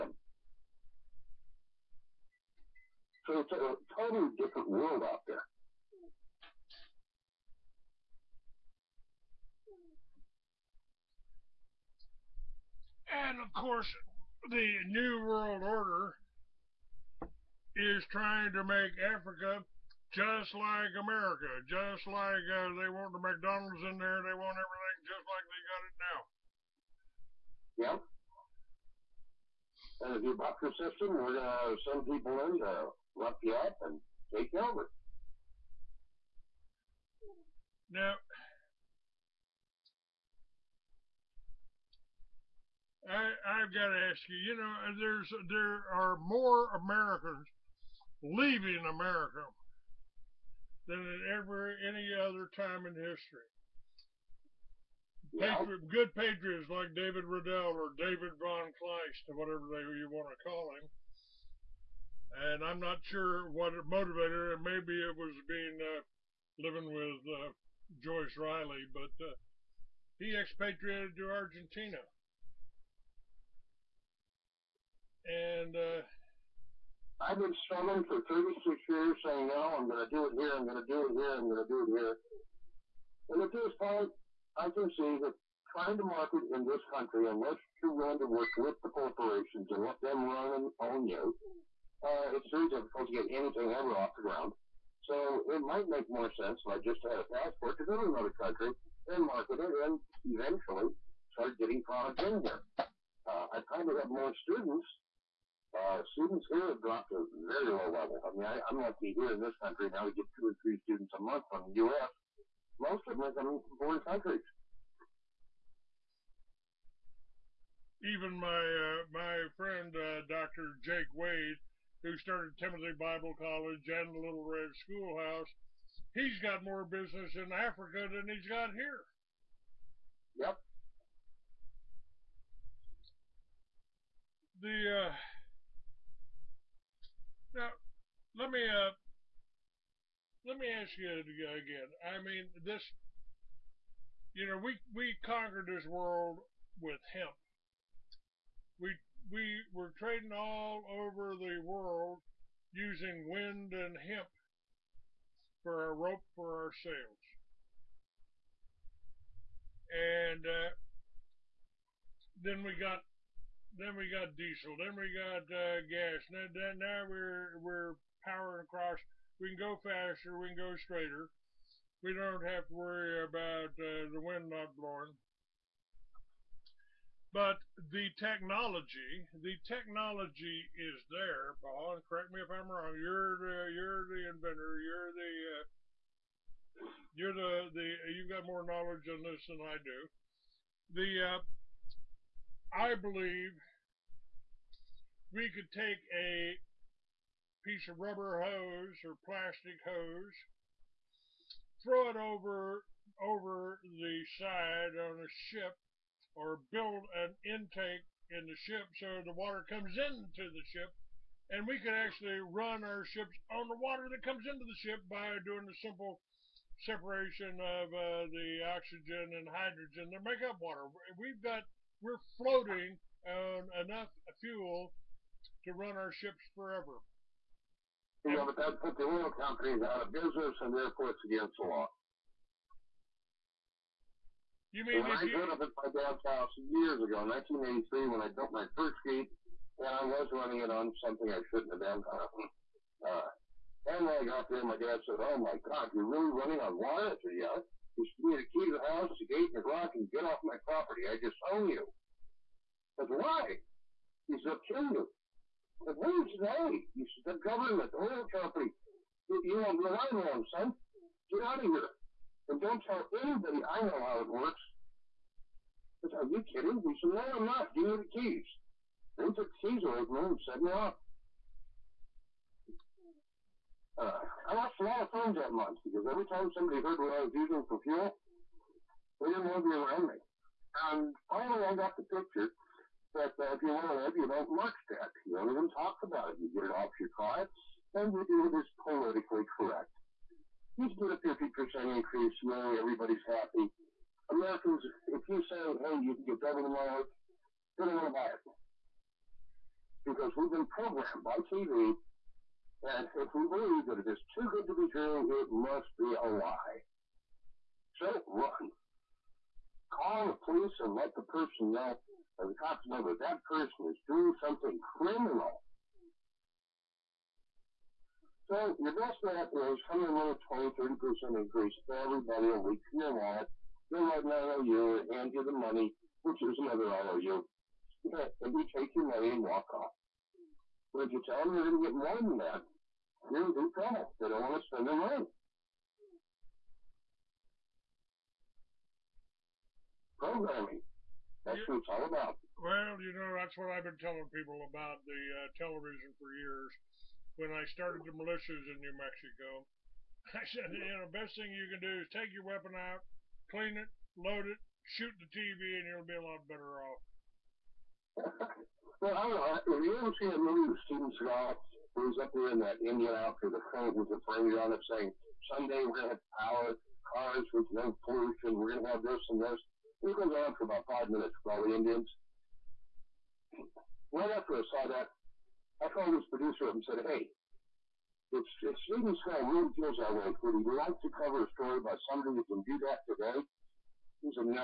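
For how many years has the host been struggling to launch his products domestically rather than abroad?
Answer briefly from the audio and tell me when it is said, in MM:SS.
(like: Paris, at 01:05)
36, at 01:18.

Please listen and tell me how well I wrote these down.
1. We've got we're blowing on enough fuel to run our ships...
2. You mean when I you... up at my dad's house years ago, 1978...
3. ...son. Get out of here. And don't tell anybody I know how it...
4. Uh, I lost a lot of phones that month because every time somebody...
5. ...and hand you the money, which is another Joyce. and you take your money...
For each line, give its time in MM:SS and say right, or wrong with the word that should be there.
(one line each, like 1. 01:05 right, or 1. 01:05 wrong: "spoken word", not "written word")
1. 03:41 wrong: "floating", not "blowing"
2. 03:54 wrong: "1983", not "1978"
3. 04:20 right
4. 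04:33 right
5. 05:24 wrong: "IOU", not "Joyce".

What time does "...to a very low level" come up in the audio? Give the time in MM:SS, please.
01:47.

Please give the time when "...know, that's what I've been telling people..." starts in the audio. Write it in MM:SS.
05:43.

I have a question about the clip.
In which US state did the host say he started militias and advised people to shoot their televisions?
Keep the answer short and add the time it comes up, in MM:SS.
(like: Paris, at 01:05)
New Mexico, at 05:48.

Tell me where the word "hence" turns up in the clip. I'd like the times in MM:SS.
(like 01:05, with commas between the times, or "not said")
not said.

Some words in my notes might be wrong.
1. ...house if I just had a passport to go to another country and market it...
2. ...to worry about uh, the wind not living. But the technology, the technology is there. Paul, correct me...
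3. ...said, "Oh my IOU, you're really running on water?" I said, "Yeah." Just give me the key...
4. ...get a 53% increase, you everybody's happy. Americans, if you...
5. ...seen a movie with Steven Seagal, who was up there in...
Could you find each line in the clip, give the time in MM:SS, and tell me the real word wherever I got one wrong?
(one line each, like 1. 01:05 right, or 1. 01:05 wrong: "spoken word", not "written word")
1. 01:36 wrong: "sense", not "house"
2. 02:52 wrong: "blowing", not "living"
3. 04:05 wrong: "God", not "IOU"
4. 04:50 wrong: "50", not "53"
5. 06:00 right.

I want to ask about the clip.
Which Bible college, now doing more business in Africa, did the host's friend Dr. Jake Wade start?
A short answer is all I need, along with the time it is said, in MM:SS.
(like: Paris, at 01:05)
Timothy Bible College, at 02:02.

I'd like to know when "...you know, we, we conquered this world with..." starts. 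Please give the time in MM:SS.
02:24.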